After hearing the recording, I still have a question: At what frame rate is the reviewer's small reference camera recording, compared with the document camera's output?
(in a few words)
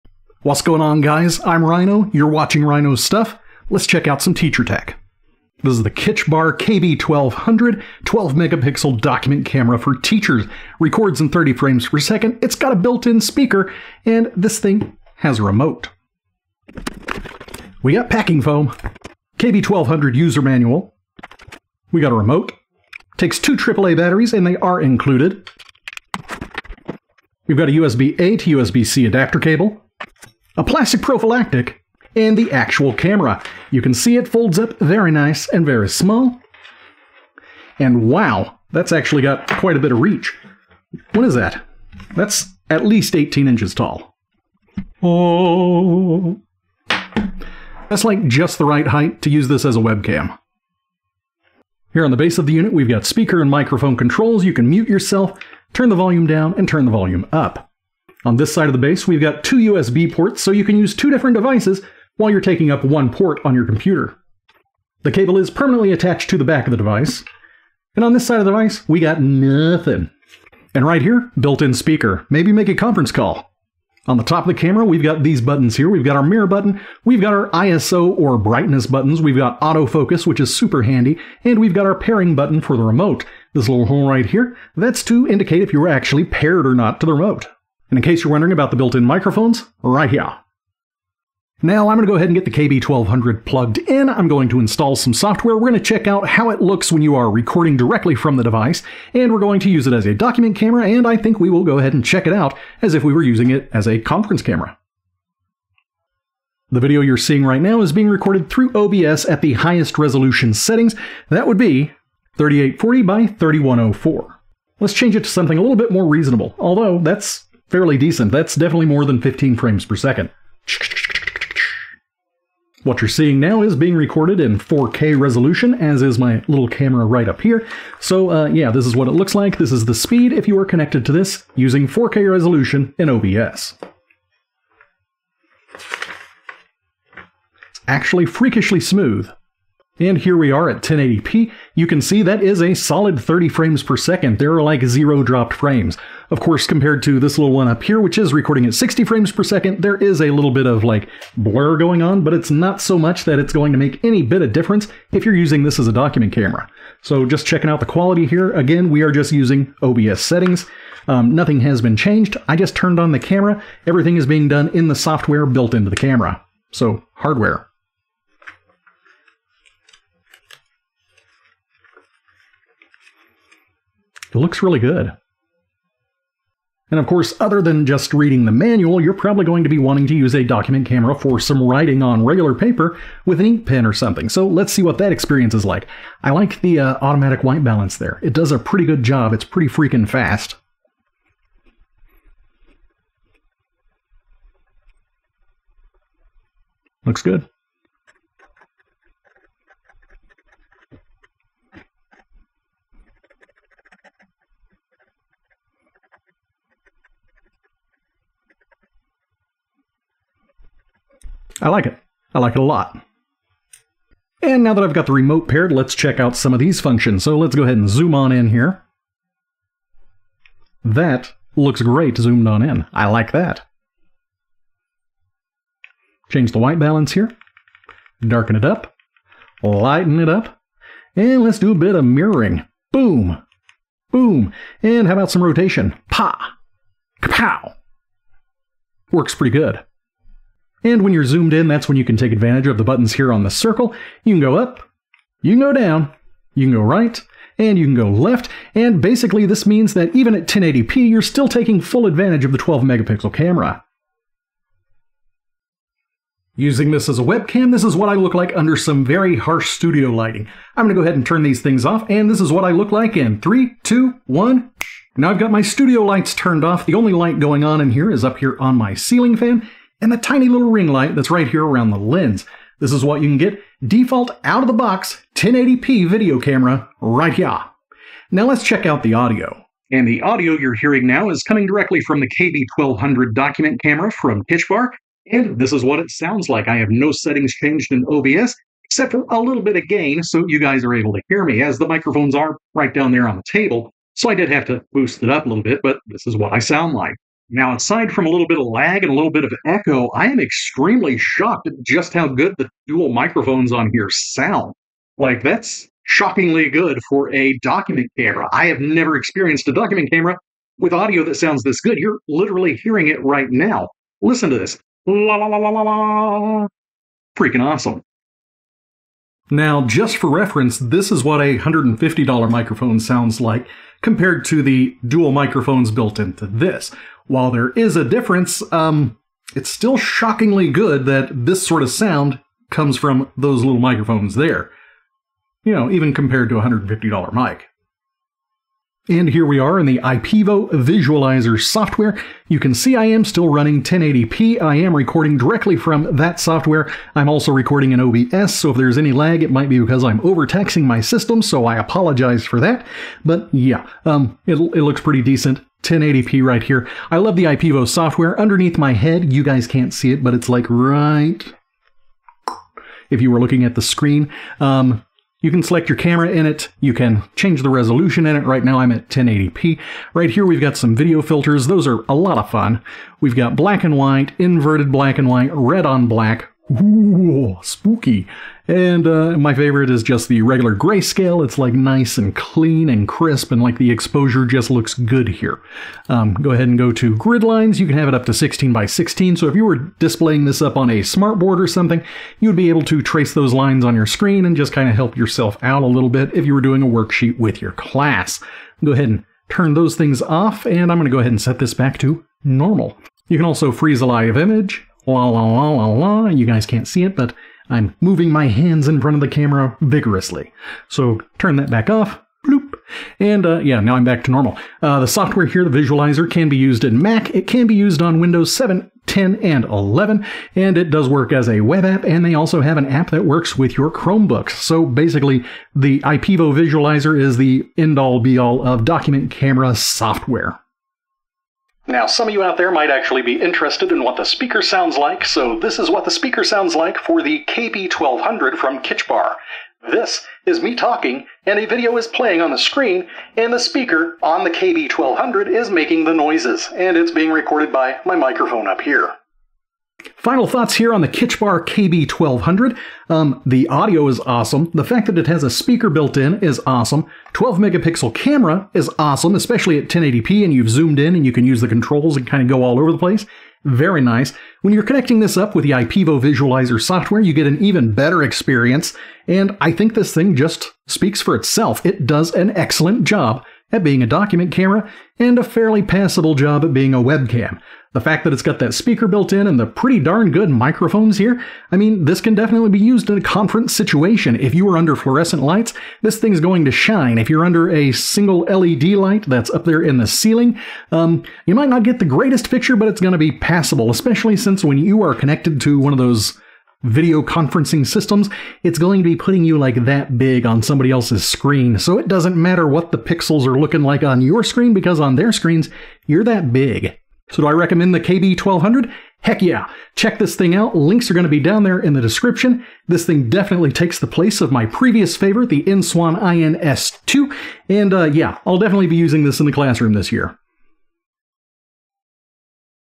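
60 frames per second.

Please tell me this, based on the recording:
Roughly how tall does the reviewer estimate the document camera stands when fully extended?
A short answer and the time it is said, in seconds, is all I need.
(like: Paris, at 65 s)
18 inches, at 43 s.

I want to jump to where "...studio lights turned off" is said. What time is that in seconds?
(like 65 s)
265 s.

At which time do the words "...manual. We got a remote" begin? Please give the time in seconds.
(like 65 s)
20 s.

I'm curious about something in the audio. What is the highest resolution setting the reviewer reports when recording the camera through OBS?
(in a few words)
3840 by 3104.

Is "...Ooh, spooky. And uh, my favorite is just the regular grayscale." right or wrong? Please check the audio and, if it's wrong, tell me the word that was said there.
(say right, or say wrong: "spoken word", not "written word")
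right.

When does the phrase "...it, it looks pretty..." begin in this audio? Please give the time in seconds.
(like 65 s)
354 s.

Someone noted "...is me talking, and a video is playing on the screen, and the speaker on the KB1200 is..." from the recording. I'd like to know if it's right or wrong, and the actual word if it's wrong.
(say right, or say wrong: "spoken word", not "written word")
right.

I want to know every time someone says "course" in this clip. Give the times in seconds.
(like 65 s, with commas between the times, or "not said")
146 s, 177 s.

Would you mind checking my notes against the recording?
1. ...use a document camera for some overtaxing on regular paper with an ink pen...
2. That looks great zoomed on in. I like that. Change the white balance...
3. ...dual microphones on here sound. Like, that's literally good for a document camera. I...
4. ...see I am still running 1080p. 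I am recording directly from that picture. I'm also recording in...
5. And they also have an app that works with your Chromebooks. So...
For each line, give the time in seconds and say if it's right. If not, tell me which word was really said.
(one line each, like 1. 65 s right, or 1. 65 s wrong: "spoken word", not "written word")
1. 180 s wrong: "writing", not "overtaxing"
2. 220 s right
3. 302 s wrong: "shockingly", not "literally"
4. 342 s wrong: "software", not "picture"
5. 422 s right.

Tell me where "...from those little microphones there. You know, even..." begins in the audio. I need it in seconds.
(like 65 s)
332 s.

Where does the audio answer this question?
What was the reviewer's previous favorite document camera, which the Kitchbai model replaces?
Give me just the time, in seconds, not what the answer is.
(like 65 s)
515 s.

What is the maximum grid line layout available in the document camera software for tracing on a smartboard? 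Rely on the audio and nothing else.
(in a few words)
16 by 16.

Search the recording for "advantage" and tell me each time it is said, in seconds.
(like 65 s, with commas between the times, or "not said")
242 s, 252 s.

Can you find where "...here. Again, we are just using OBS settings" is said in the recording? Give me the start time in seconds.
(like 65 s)
158 s.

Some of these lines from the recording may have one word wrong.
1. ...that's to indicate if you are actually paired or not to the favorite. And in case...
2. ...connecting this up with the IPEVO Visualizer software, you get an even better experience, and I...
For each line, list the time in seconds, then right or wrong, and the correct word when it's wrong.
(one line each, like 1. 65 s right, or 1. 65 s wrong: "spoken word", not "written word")
1. 84 s wrong: "remote", not "favorite"
2. 464 s right.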